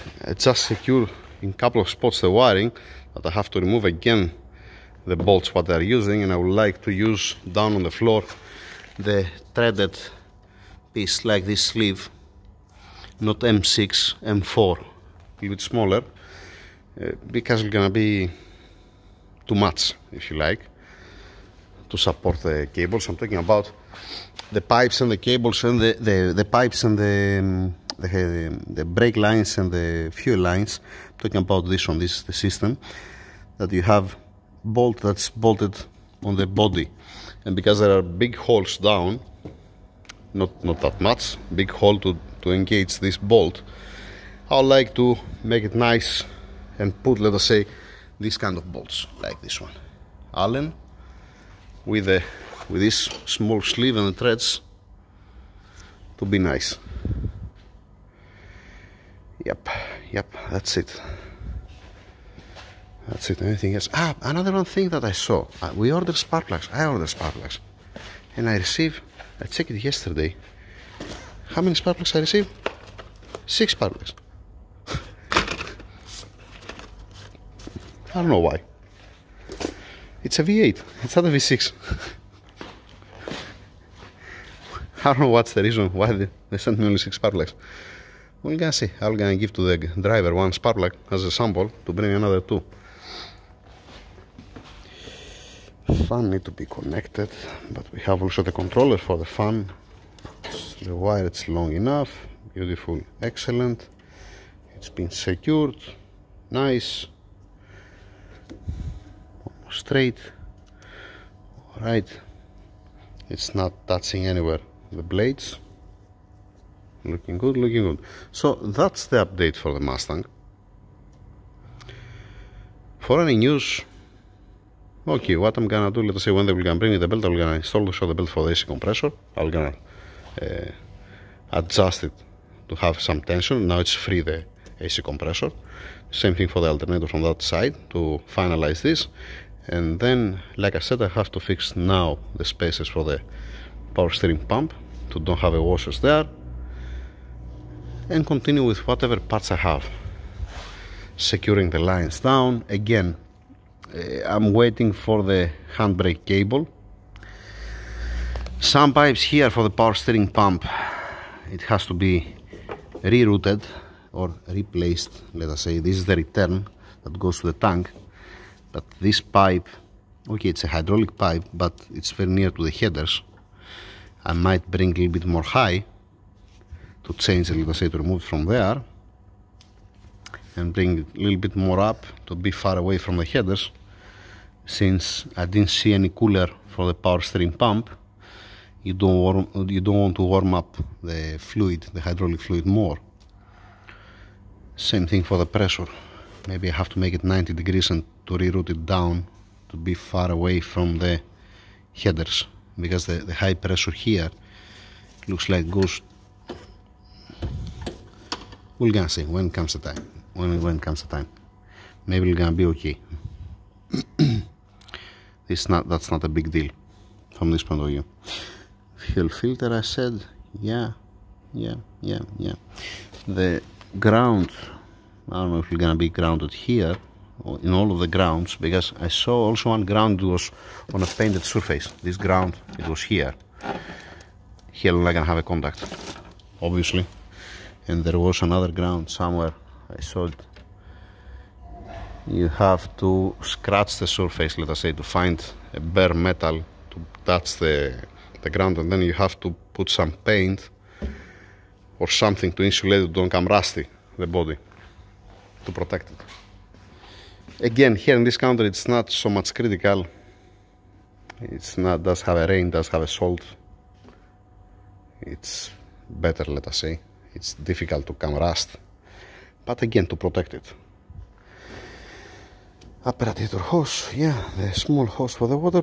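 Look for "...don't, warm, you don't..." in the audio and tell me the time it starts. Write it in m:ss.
3:08.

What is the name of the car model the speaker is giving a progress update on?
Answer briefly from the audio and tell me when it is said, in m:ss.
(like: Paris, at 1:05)
Mustang, at 1:59.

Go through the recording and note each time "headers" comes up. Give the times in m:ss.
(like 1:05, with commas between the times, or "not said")
2:52, 3:03, 3:21.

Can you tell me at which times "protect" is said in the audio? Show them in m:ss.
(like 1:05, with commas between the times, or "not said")
4:15, 4:30.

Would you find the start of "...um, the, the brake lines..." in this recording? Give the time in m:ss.
0:27.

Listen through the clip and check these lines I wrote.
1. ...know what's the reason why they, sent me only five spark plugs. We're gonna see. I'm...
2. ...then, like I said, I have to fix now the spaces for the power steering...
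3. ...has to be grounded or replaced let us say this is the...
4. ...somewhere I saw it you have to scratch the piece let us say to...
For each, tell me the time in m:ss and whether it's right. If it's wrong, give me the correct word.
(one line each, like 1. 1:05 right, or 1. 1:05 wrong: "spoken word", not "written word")
1. 1:25 wrong: "six", not "five"
2. 2:19 right
3. 2:41 wrong: "rerouted", not "grounded"
4. 3:59 wrong: "surface", not "piece".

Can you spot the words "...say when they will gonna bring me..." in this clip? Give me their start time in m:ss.
2:06.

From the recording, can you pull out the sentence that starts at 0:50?
Allen, with, a, with this small sleeve and the threads, to be nice.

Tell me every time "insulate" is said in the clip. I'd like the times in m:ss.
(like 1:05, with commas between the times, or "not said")
4:12.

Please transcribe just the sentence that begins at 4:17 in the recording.
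Again, here in this country, it's not so much critical.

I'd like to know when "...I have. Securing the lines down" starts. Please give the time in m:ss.
2:29.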